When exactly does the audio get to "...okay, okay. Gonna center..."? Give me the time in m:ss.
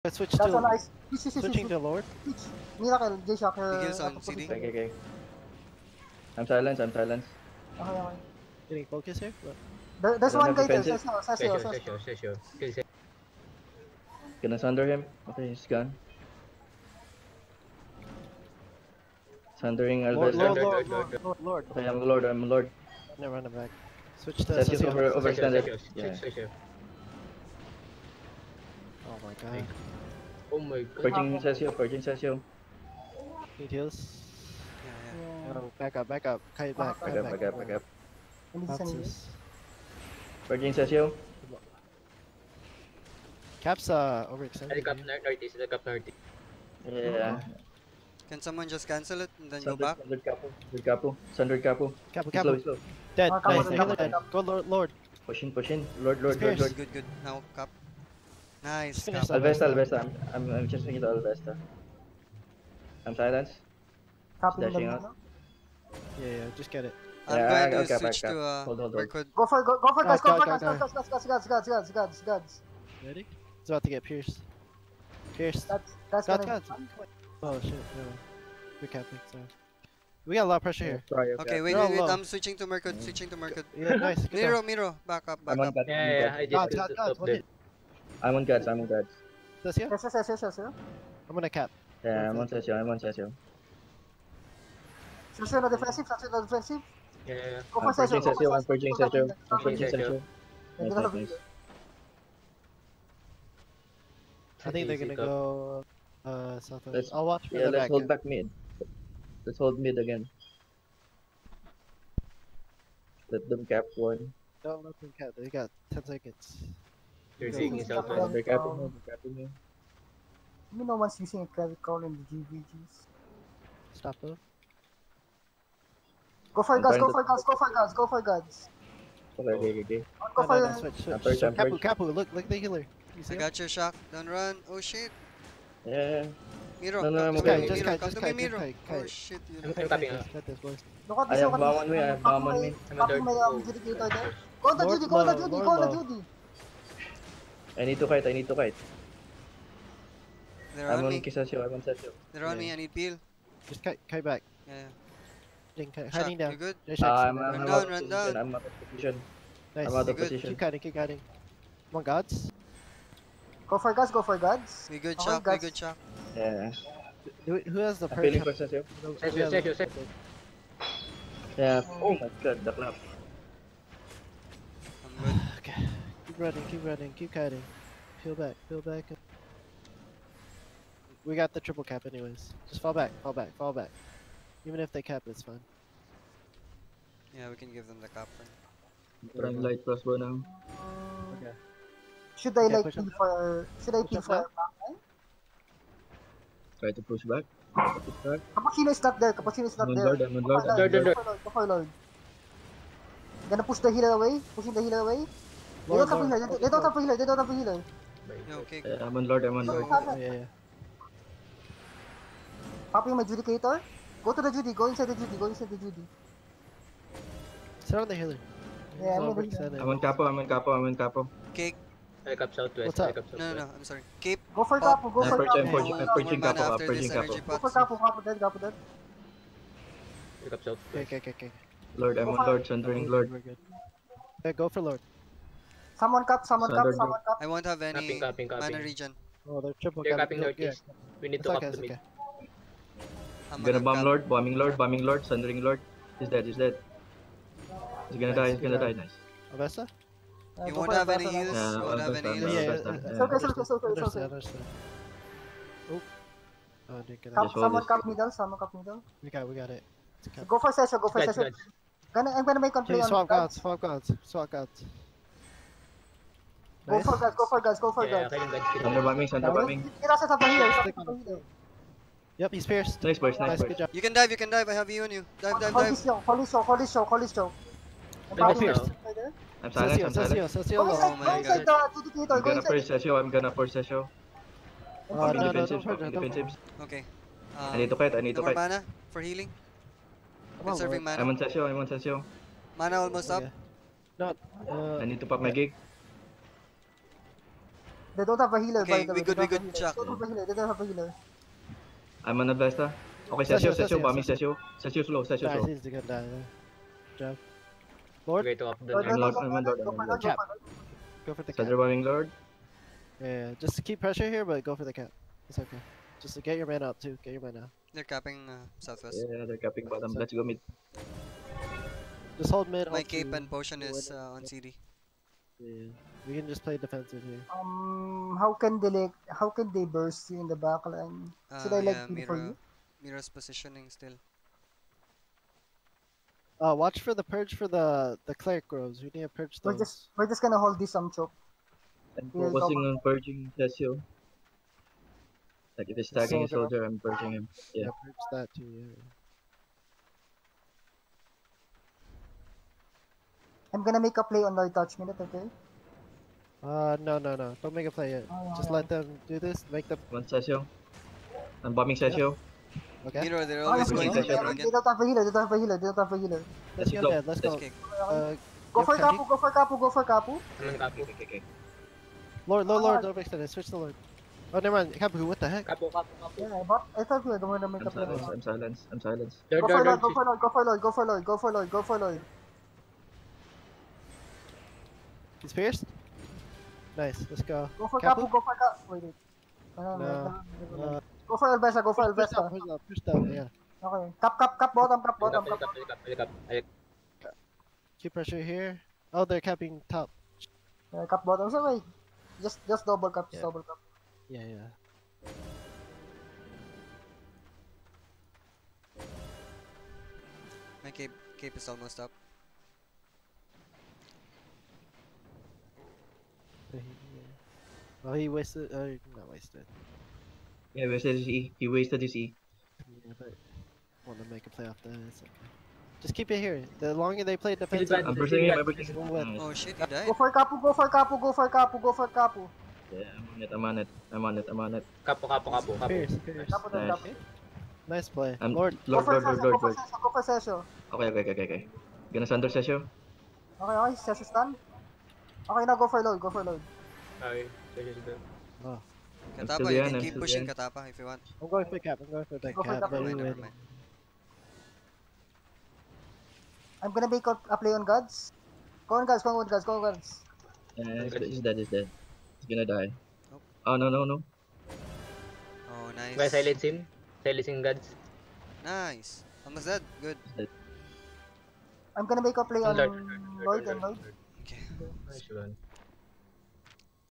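7:21.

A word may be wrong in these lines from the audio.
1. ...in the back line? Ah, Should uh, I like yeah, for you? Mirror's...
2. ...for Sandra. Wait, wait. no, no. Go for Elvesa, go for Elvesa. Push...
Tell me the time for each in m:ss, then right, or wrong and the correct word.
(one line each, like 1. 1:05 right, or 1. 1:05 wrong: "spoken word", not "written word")
1. 5:30 right
2. 6:28 wrong: "Capu", not "Sandra".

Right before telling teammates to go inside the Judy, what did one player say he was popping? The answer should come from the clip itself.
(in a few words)
Judicator.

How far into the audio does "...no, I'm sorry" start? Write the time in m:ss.
3:43.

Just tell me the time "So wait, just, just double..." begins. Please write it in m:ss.
6:41.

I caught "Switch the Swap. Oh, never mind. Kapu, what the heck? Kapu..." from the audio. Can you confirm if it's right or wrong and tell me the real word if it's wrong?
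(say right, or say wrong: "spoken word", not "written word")
wrong: "Lord", not "Swap".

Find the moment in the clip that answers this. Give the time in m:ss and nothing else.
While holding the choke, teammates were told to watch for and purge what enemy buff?
5:38.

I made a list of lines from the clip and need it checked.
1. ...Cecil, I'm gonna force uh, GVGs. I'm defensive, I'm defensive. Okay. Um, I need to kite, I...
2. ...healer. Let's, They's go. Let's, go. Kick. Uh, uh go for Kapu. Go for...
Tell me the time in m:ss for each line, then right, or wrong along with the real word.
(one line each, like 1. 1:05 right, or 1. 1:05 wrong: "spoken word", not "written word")
1. 4:42 wrong: "Cecil", not "GVGs"
2. 6:06 wrong: "Let", not "They".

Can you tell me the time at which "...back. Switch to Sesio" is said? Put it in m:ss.
0:23.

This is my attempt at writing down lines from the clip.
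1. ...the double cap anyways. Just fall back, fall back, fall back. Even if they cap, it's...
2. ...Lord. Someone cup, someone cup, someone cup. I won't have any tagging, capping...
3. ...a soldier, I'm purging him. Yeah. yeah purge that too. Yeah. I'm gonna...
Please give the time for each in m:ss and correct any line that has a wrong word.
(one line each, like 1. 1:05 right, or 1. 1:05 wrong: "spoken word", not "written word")
1. 3:01 wrong: "triple", not "double"
2. 3:54 wrong: "capping", not "tagging"
3. 5:46 right.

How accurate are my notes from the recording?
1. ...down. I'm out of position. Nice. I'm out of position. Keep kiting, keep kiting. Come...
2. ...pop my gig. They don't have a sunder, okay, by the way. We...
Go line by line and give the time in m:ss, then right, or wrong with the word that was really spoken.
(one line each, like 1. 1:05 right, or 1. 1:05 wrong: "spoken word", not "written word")
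1. 2:38 right
2. 4:55 wrong: "healer", not "sunder".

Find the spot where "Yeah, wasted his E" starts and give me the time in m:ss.
7:00.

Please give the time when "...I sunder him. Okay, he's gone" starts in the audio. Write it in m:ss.
0:14.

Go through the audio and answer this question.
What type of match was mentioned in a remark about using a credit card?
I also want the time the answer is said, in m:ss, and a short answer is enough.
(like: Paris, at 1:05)
GVGs, at 2:02.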